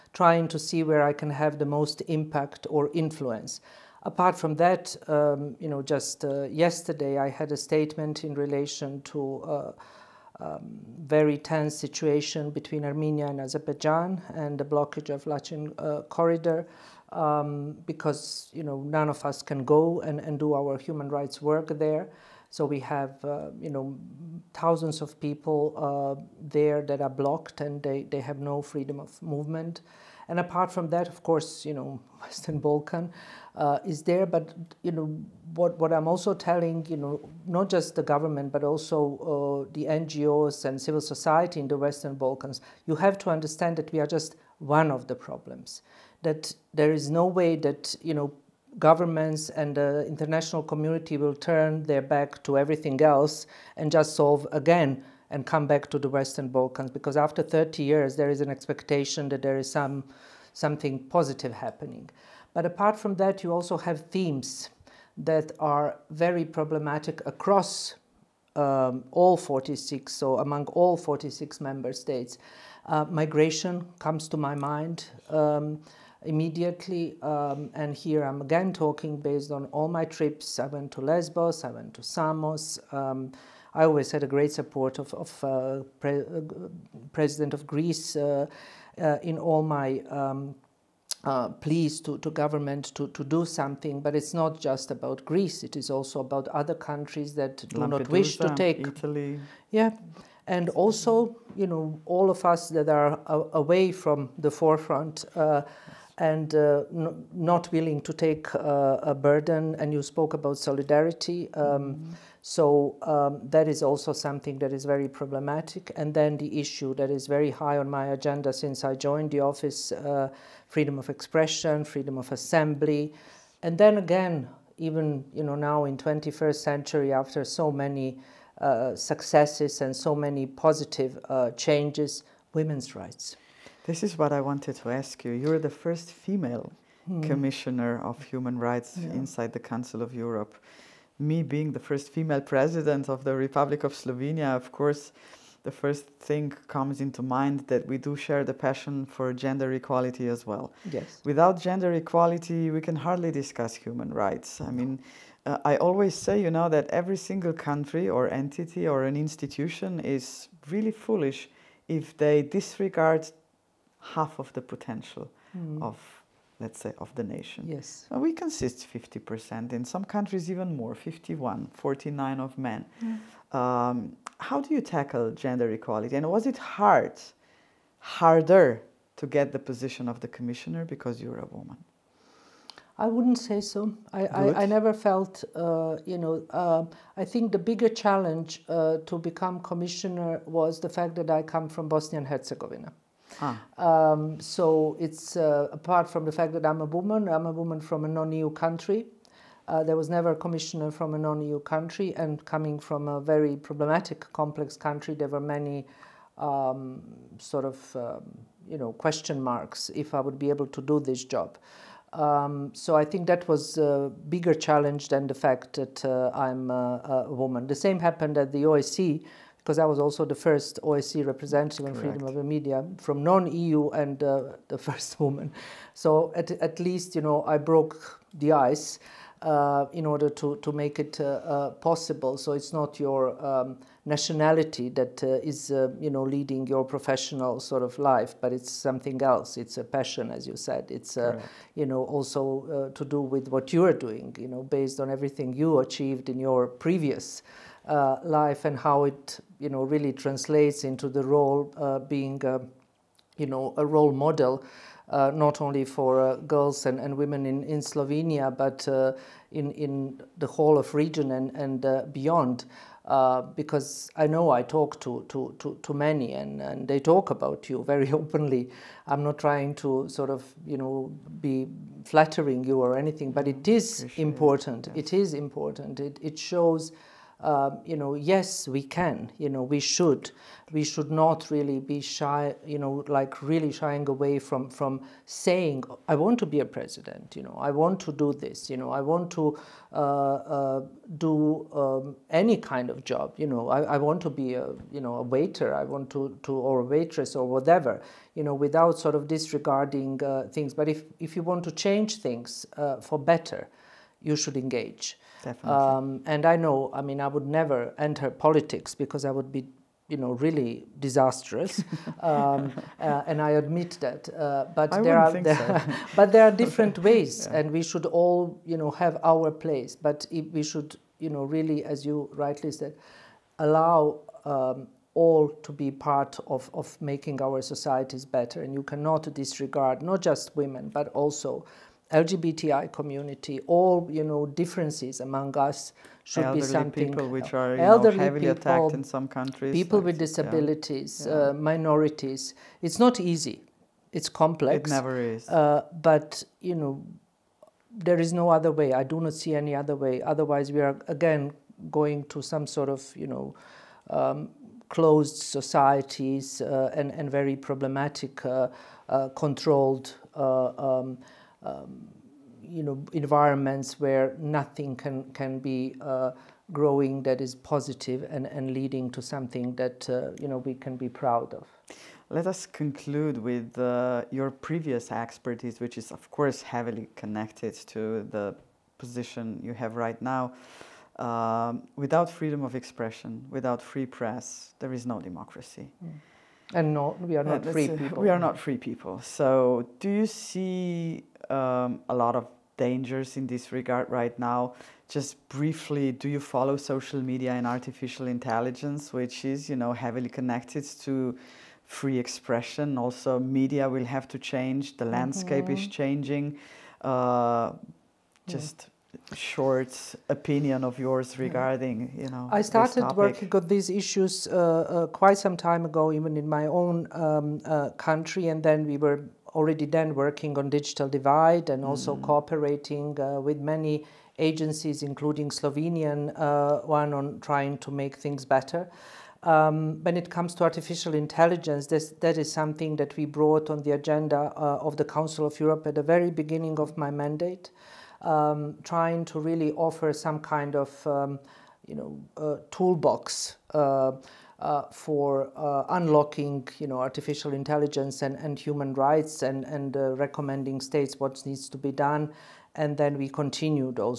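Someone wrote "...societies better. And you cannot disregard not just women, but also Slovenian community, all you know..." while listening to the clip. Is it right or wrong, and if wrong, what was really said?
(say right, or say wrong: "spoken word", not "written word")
wrong: "LGBTI", not "Slovenian".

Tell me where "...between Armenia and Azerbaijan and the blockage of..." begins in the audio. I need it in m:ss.
0:12.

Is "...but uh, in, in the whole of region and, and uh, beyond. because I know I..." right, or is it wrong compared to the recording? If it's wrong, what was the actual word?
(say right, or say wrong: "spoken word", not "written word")
right.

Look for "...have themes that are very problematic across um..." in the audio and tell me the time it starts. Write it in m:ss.
1:03.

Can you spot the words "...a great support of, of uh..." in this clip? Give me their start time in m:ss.
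1:24.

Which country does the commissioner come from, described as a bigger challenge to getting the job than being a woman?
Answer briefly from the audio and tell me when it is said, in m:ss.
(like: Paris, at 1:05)
Bosnia and Herzegovina, at 3:11.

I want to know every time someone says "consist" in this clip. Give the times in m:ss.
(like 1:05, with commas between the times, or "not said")
2:48.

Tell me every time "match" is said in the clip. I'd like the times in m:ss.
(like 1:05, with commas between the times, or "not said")
not said.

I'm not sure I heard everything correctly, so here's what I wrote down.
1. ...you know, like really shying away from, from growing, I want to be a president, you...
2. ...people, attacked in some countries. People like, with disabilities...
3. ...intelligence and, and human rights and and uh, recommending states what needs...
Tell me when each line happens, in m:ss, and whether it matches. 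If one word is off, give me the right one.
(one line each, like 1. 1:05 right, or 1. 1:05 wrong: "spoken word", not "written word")
1. 4:42 wrong: "saying", not "growing"
2. 5:38 right
3. 7:27 right.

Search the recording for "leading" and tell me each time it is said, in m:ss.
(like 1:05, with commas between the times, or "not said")
3:56, 6:08.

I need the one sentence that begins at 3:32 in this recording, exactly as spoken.
Um, so I think that was a bigger challenge than the fact that uh, I'm a, a, woman.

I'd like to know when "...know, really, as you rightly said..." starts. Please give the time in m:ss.
5:21.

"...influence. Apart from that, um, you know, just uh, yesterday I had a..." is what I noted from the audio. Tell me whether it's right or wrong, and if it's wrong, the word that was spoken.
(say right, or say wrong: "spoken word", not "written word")
right.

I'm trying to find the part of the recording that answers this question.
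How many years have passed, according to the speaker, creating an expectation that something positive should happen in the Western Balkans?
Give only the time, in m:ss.
0:57.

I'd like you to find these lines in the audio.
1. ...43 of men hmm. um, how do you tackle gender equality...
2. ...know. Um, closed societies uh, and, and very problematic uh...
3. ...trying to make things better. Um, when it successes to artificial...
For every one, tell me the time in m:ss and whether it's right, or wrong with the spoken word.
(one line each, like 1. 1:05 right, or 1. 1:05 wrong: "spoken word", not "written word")
1. 2:51 wrong: "49", not "43"
2. 5:53 right
3. 7:07 wrong: "comes", not "successes".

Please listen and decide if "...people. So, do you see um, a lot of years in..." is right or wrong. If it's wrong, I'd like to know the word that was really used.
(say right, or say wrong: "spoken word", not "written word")
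wrong: "dangers", not "years".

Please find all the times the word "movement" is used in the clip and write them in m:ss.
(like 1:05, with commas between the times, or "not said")
0:29.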